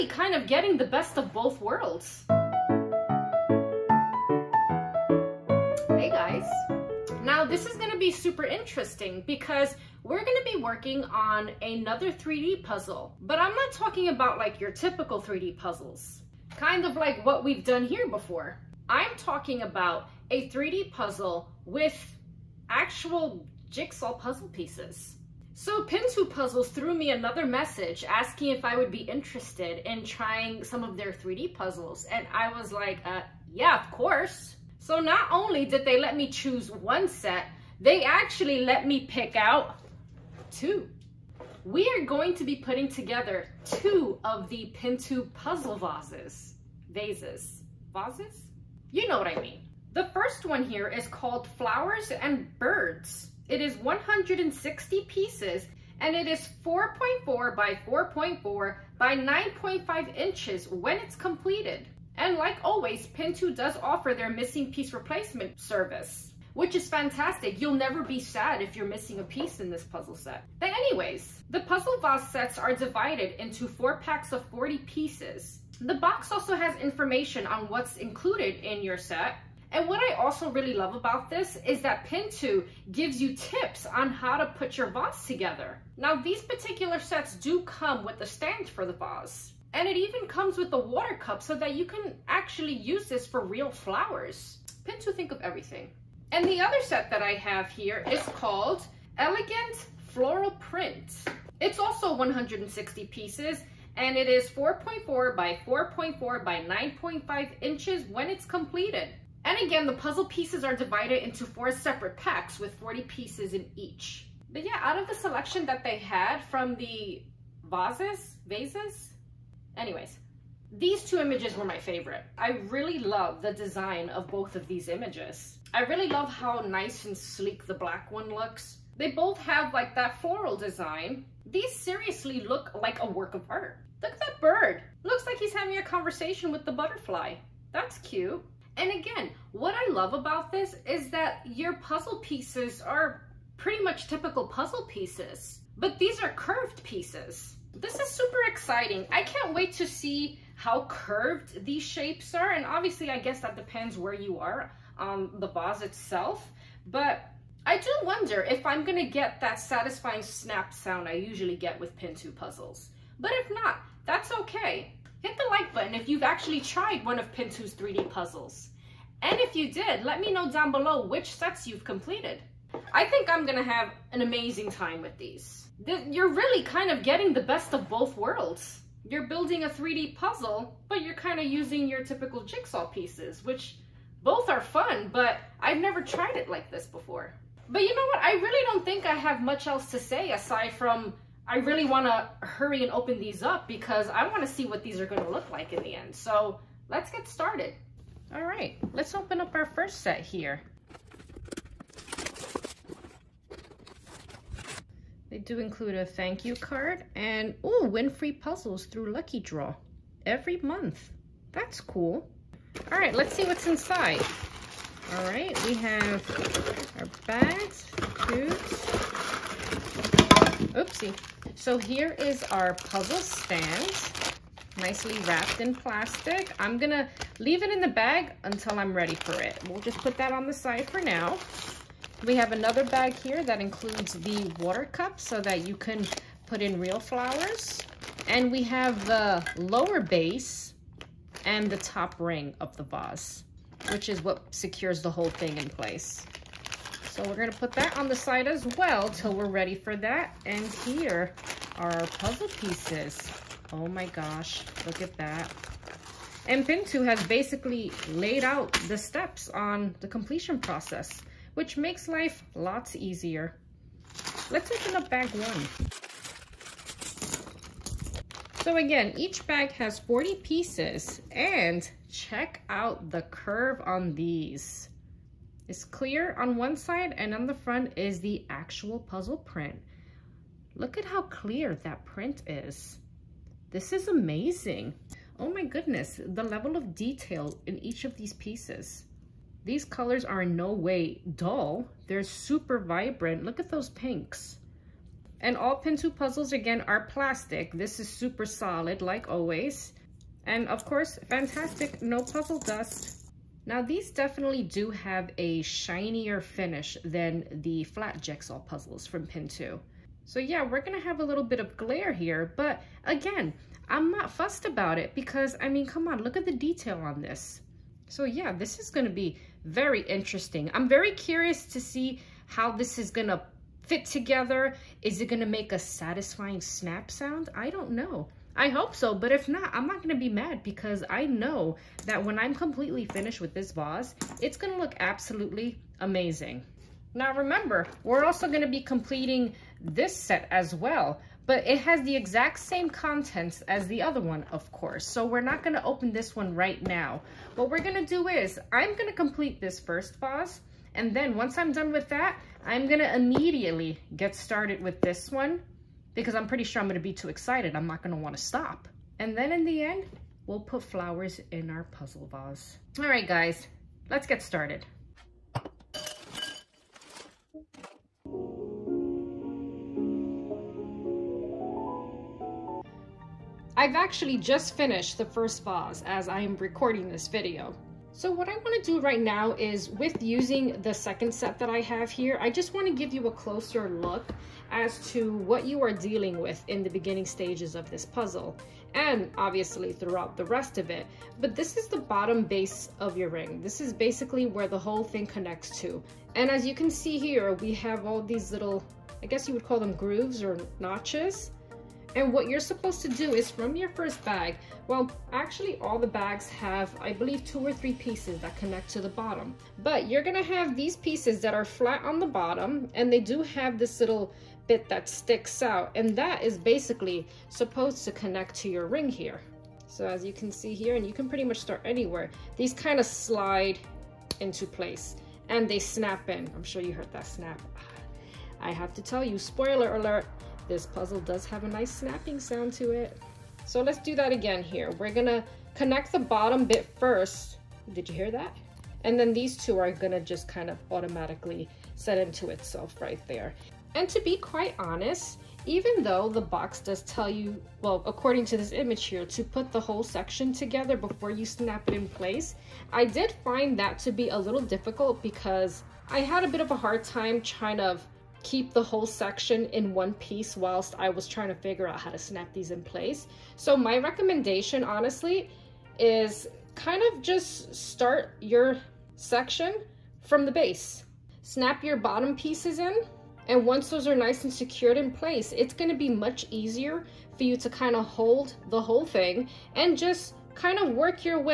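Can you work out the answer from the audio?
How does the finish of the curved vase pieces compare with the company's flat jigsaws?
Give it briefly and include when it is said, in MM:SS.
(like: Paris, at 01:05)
shinier finish, at 05:05.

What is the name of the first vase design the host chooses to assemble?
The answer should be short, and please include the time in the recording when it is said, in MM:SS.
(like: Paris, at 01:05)
Flowers and Birds, at 00:51.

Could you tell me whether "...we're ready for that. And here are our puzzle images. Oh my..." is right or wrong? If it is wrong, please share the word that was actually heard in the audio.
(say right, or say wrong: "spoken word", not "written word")
wrong: "pieces", not "images".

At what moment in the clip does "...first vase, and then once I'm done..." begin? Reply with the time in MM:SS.
05:49.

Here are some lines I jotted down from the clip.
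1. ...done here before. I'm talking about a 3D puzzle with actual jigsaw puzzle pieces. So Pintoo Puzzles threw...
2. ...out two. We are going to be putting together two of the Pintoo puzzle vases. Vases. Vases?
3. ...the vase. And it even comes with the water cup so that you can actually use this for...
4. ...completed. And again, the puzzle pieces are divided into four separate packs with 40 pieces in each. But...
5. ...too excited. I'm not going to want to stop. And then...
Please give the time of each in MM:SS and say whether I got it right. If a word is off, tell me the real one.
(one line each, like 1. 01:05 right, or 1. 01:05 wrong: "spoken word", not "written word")
1. 00:17 right
2. 00:39 right
3. 01:28 right
4. 01:48 right
5. 05:57 right.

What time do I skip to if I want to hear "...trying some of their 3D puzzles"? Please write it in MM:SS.
00:30.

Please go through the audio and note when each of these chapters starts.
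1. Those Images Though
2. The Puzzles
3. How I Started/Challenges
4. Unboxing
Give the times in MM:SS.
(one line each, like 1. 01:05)
1. 01:54
2. 00:49
3. 06:05
4. 03:17.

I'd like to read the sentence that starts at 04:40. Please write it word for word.
Look at how clear that print is.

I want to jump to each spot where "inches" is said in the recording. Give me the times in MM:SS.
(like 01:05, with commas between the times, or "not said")
01:00, 01:47.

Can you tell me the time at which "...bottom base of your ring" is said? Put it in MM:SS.
06:32.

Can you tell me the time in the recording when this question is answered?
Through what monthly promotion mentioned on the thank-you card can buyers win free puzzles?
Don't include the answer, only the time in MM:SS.
03:29.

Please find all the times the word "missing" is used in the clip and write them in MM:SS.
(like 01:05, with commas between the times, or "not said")
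01:04, 01:08.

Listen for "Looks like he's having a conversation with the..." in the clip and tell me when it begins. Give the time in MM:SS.
02:15.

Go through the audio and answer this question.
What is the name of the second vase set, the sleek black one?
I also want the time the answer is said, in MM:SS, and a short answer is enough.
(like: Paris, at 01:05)
Elegant Floral Print, at 01:39.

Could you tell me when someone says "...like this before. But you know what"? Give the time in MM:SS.
03:06.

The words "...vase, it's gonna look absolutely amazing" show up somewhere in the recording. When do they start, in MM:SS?
05:33.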